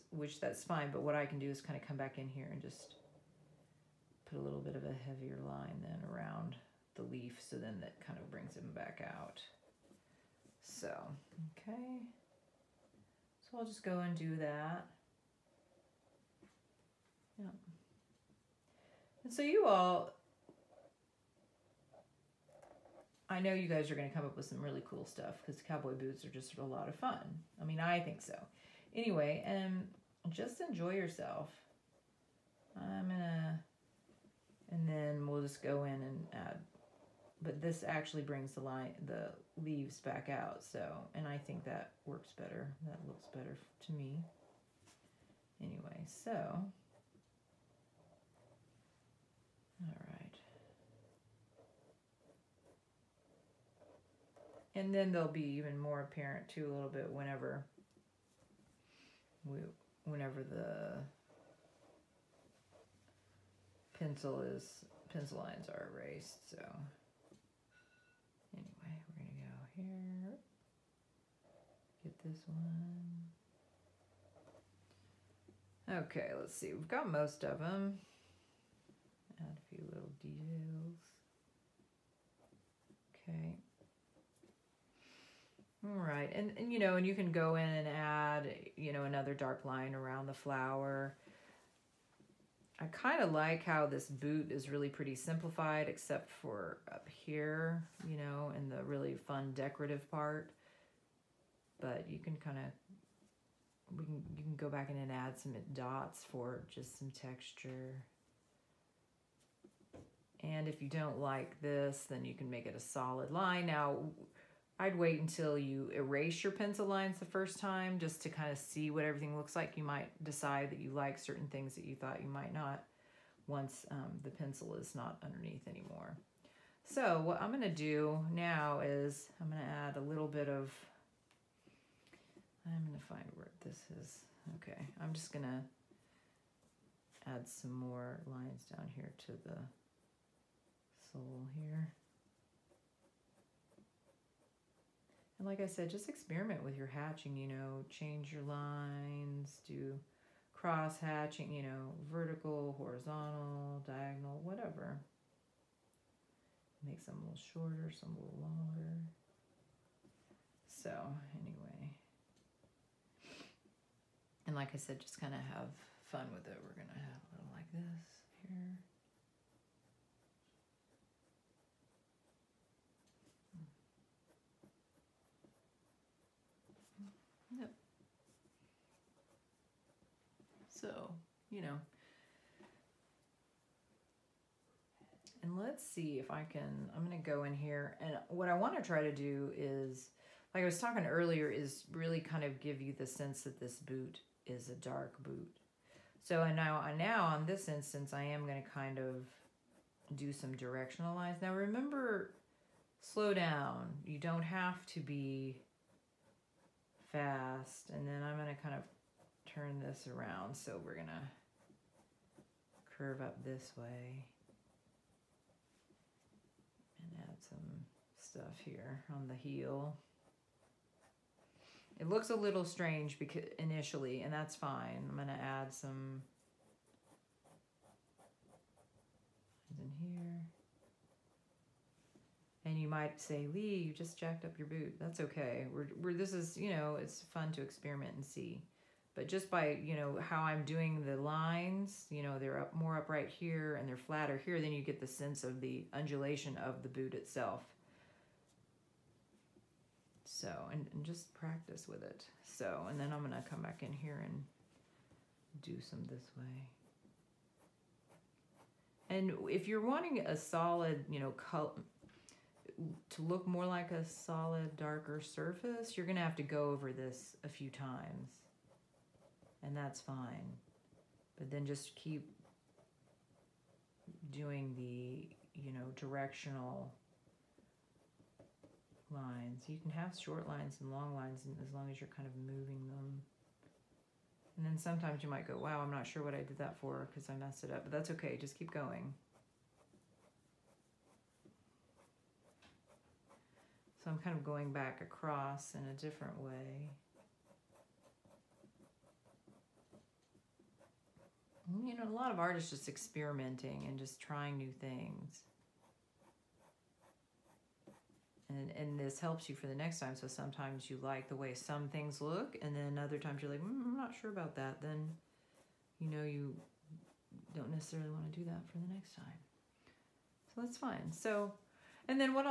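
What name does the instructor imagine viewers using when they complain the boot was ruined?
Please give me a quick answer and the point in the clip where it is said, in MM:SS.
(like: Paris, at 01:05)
Leigh, at 03:53.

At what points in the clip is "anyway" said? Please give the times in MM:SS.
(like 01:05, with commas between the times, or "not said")
00:28, 00:45, 01:08, 02:41.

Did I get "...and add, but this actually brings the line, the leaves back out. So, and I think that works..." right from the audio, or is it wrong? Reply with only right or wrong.
right.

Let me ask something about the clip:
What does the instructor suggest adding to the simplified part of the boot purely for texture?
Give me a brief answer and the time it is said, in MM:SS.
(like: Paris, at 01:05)
dots, at 01:45.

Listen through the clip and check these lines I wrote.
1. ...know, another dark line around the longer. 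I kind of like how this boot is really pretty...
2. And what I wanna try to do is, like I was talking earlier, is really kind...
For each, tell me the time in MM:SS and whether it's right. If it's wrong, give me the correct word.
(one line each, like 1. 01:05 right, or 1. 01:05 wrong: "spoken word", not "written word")
1. 01:28 wrong: "flower", not "longer"
2. 03:07 right.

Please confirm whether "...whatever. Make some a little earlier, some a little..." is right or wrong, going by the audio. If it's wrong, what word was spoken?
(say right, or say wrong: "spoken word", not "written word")
wrong: "shorter", not "earlier".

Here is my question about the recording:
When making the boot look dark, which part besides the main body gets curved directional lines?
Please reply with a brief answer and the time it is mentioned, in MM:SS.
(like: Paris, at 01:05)
the heel, at 03:39.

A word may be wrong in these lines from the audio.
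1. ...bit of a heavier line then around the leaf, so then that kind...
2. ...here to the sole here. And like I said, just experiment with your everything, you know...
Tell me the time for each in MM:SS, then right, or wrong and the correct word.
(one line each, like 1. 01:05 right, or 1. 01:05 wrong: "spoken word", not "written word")
1. 00:04 right
2. 02:18 wrong: "hatching", not "everything".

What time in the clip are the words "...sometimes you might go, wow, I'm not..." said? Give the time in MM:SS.
04:44.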